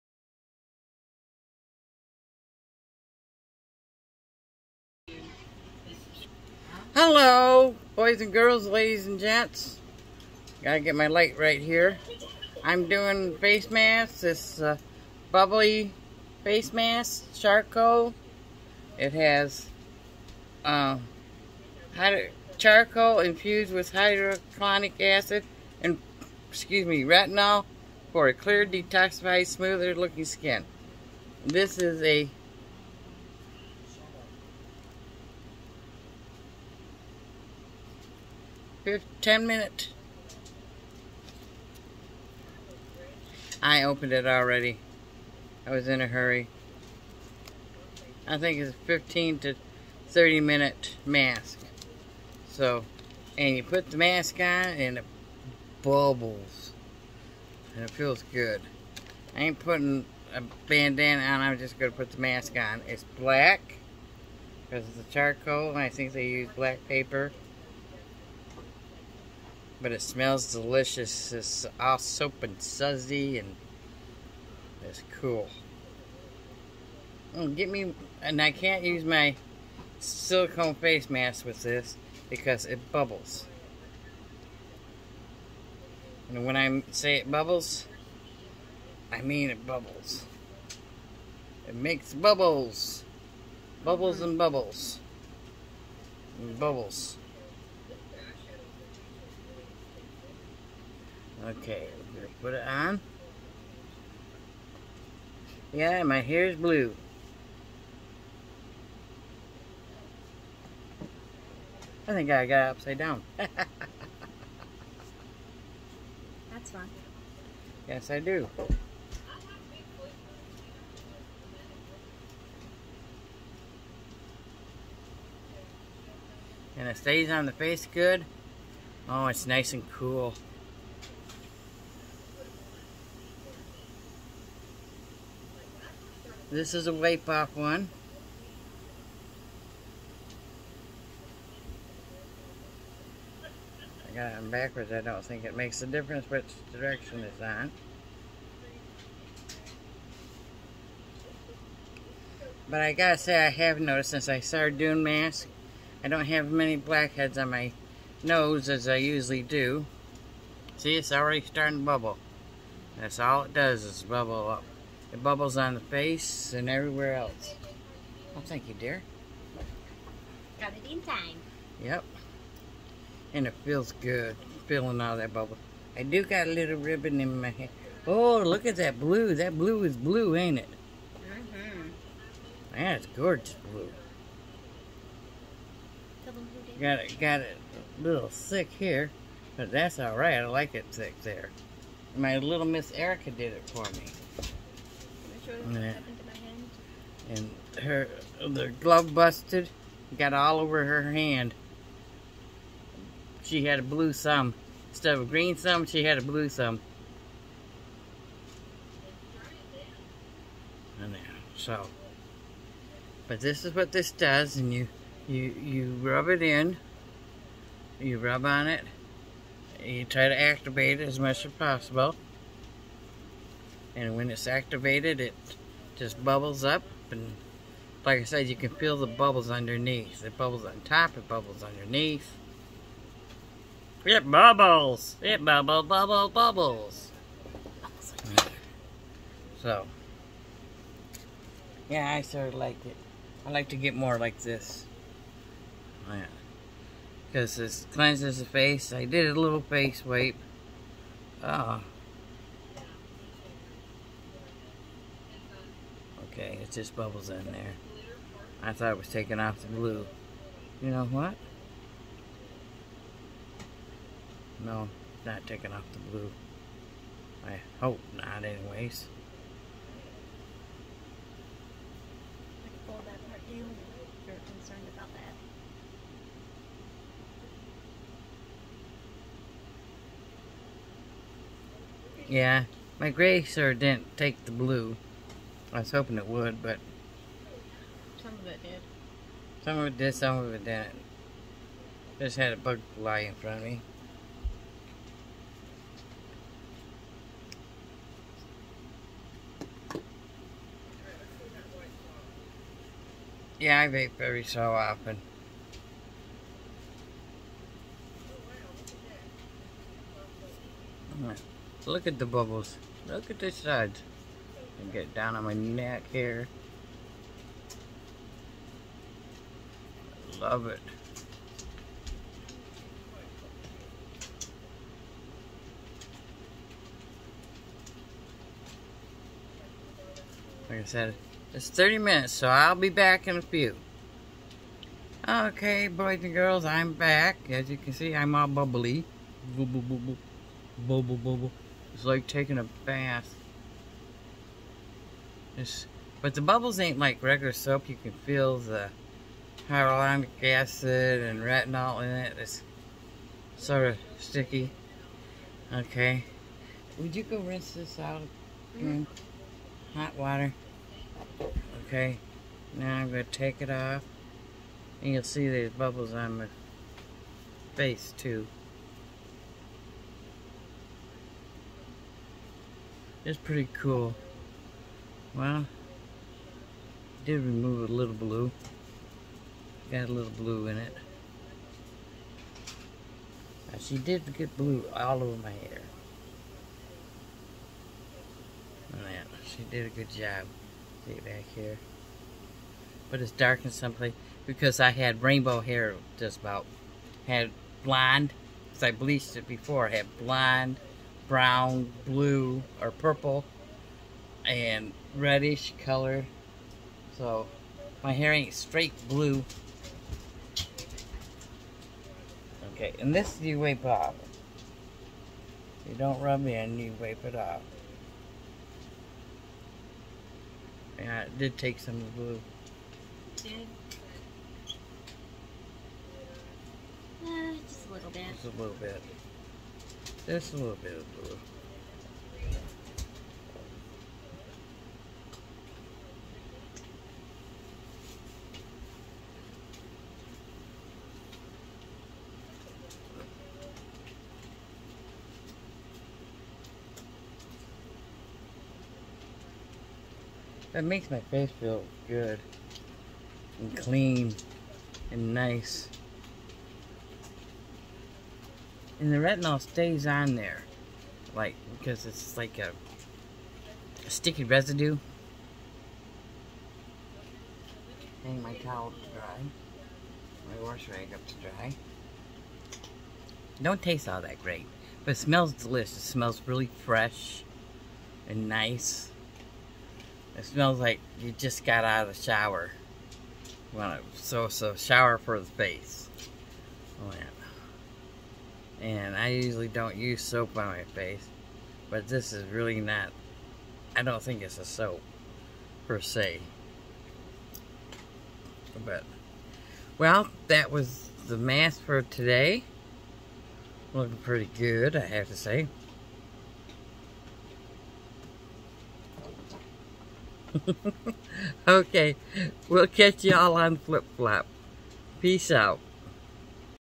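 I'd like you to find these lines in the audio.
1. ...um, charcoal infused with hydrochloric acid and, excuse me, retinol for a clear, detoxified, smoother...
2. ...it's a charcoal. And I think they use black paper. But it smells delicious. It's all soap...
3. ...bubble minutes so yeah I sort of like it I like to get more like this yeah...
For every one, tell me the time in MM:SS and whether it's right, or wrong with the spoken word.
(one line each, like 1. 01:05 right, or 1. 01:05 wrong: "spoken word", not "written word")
1. 00:21 right
2. 01:04 right
3. 03:55 wrong: "bubbles", not "minutes".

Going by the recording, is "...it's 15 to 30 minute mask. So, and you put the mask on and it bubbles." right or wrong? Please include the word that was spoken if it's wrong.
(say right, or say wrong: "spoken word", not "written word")
right.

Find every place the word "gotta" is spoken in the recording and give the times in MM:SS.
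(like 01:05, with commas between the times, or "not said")
00:10, 02:32.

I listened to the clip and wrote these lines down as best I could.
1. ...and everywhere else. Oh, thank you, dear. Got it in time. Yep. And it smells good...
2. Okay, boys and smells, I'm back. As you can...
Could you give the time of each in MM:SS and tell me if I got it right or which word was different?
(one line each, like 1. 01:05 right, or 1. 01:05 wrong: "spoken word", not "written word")
1. 02:46 wrong: "feels", not "smells"
2. 05:35 wrong: "girls", not "smells".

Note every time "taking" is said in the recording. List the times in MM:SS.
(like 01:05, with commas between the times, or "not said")
04:19, 04:25, 05:42.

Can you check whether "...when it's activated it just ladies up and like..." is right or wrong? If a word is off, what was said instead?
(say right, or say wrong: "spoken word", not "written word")
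wrong: "bubbles", not "ladies".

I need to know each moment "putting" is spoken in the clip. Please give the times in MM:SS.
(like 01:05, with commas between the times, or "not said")
00:59.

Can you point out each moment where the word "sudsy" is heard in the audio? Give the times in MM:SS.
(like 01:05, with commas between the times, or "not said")
01:12.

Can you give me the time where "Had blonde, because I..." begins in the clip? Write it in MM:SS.
06:37.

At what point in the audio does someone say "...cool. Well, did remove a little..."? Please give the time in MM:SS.
06:13.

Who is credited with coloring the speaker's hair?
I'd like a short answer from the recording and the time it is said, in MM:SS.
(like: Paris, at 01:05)
Erica, at 03:12.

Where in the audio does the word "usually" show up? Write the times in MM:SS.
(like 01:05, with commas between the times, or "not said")
02:38, 08:09.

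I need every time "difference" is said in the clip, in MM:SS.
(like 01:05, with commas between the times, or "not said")
02:25.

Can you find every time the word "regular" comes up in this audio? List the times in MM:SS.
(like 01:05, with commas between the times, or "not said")
05:47.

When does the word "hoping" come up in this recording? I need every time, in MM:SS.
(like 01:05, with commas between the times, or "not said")
04:45.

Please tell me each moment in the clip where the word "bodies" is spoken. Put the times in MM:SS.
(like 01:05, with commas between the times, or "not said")
not said.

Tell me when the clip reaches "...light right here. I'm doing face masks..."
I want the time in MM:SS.
00:11.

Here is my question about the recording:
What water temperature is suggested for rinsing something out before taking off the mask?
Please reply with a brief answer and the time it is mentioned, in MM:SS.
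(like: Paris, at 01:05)
hot, at 05:59.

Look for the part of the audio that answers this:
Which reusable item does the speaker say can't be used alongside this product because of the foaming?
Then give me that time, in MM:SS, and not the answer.
01:19.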